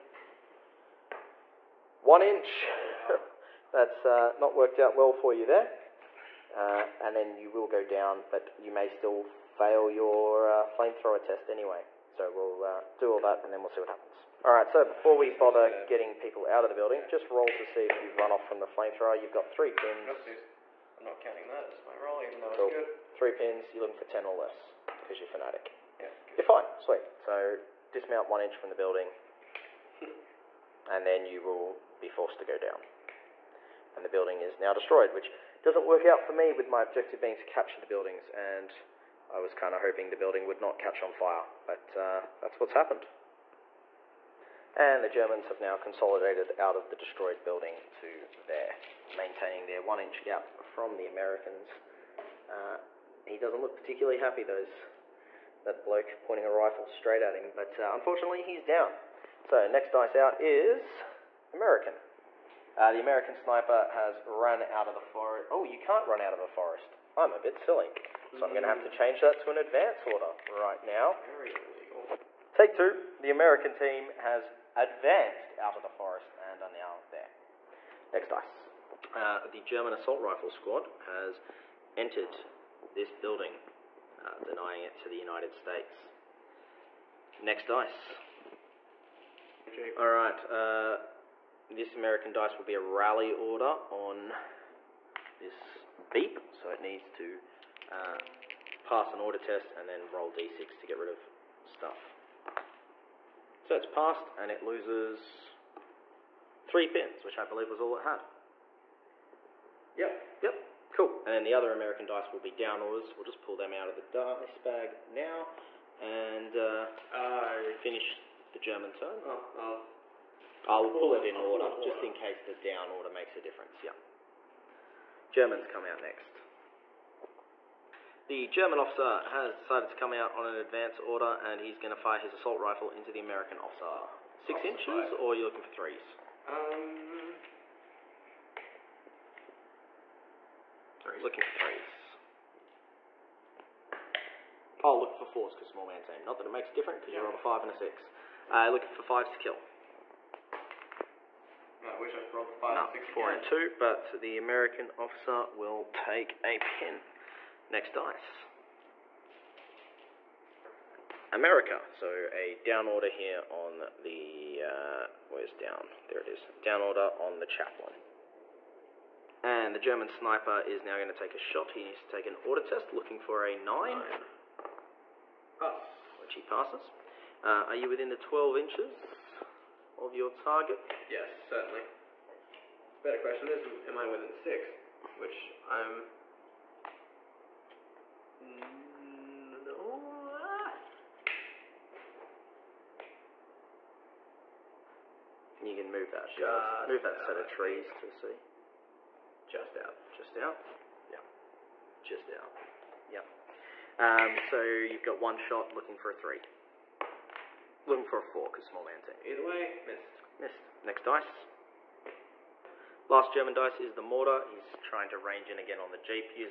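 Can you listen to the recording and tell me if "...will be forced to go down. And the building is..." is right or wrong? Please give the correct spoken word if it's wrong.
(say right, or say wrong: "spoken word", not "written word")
right.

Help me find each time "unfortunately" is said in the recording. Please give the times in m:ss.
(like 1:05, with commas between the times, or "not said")
0:57.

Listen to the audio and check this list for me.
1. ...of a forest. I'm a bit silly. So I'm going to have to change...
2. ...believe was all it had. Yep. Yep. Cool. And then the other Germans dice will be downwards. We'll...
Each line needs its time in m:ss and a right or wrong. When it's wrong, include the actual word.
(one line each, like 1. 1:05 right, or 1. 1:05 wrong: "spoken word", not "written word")
1. 1:06 right
2. 1:47 wrong: "American", not "Germans".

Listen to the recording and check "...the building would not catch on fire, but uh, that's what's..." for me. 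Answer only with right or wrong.
right.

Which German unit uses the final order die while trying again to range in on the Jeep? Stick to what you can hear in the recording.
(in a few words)
The mortar.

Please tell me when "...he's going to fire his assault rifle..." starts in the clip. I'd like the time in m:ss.
2:11.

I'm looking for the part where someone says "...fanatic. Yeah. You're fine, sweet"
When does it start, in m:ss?
0:25.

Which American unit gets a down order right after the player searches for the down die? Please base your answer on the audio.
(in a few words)
The chaplain.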